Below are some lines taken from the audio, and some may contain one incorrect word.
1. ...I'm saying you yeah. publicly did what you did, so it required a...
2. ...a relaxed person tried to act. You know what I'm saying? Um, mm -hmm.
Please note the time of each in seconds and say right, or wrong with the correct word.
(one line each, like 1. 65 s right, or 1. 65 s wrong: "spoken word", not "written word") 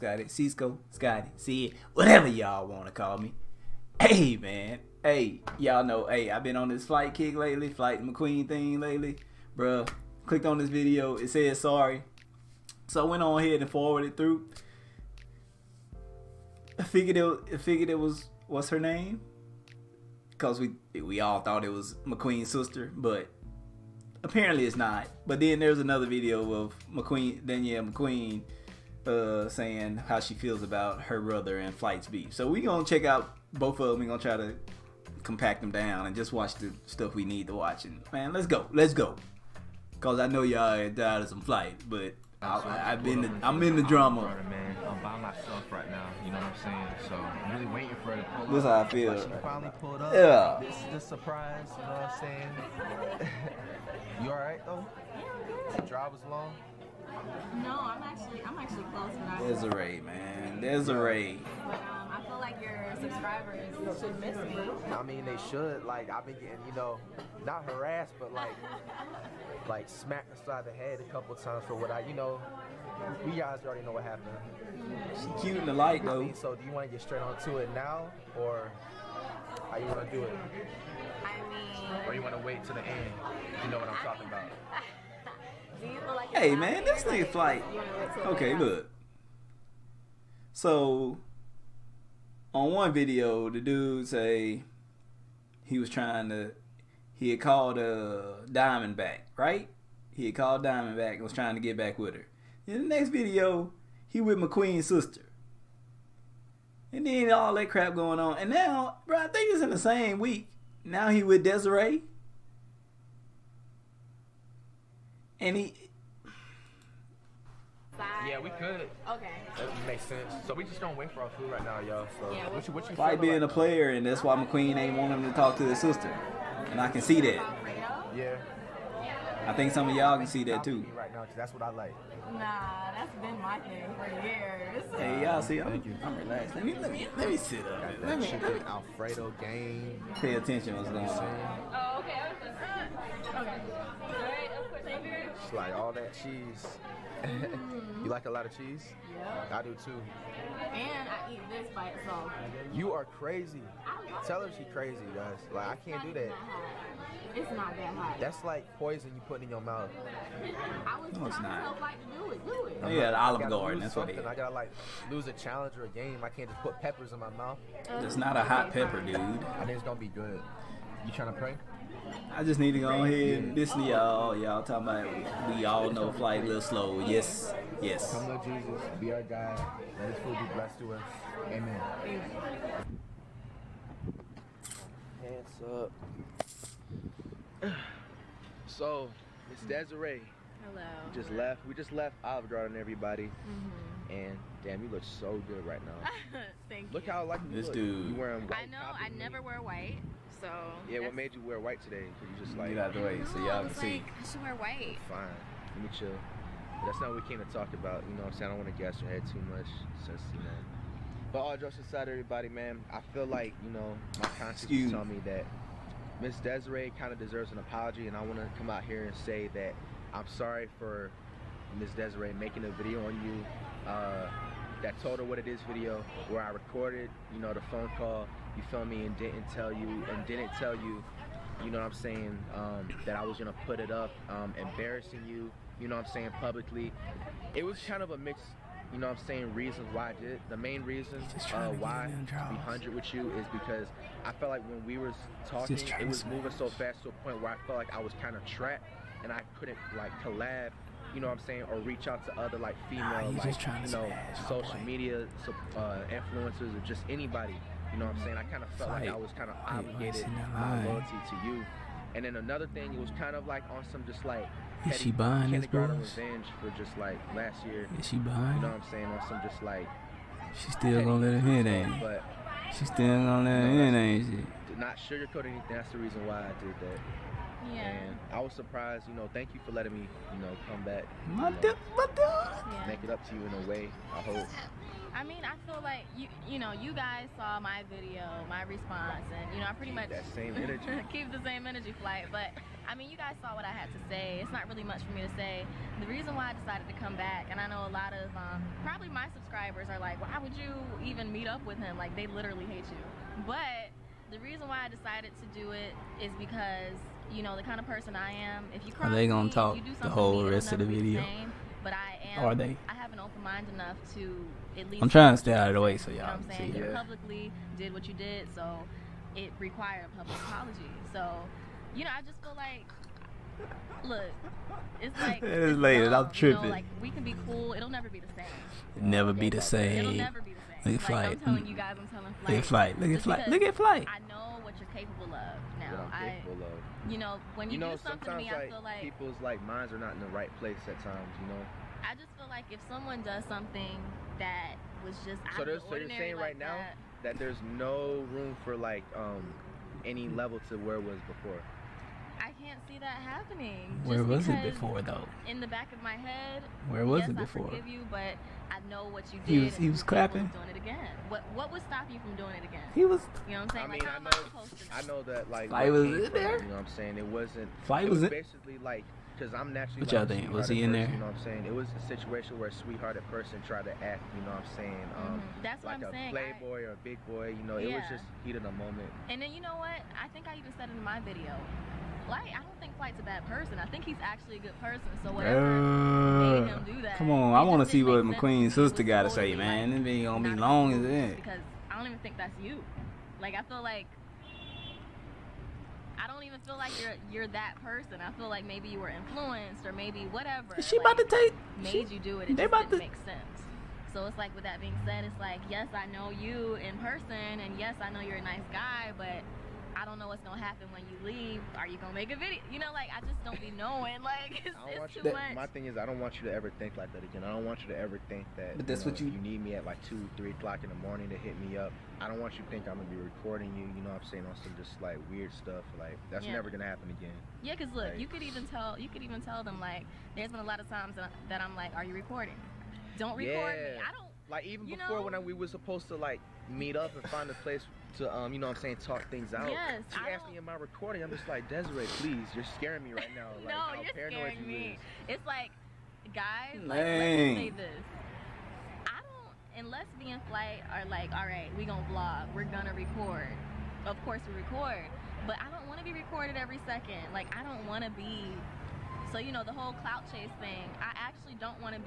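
1. 316 s right
2. 372 s wrong: "sweethearted", not "relaxed".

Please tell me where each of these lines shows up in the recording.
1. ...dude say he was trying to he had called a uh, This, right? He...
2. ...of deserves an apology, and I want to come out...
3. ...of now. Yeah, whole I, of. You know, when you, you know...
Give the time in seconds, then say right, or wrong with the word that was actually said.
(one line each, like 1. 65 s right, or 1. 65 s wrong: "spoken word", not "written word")
1. 93 s wrong: "Diamondback", not "This"
2. 217 s right
3. 335 s wrong: "capable", not "whole".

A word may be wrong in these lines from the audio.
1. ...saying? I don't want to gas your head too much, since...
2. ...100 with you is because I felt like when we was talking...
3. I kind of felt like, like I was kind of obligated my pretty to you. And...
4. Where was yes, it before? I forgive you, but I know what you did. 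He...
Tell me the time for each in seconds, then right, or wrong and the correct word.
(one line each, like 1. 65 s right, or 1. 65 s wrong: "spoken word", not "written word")
1. 208 s right
2. 242 s right
3. 258 s wrong: "loyalty", not "pretty"
4. 356 s right.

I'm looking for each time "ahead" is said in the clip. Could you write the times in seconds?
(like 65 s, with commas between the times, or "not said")
13 s, 172 s.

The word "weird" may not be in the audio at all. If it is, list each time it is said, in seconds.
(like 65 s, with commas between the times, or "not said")
425 s.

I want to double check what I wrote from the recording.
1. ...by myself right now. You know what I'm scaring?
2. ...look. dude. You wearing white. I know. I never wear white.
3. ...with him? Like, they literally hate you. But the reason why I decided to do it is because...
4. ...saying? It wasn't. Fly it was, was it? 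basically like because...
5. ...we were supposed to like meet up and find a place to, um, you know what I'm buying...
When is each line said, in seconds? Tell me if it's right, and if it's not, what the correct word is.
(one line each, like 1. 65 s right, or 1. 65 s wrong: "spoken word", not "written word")
1. 45 s wrong: "saying", not "scaring"
2. 197 s right
3. 301 s right
4. 366 s right
5. 435 s wrong: "saying", not "buying".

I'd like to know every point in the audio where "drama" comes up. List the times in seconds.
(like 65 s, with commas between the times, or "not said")
43 s.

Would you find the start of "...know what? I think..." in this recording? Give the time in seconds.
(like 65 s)
379 s.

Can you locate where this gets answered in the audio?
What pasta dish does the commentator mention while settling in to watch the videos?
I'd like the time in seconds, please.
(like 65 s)
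138 s.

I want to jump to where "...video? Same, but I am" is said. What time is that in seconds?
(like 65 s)
310 s.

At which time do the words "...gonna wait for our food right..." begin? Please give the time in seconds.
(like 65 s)
120 s.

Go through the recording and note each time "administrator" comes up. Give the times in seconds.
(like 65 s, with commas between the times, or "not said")
not said.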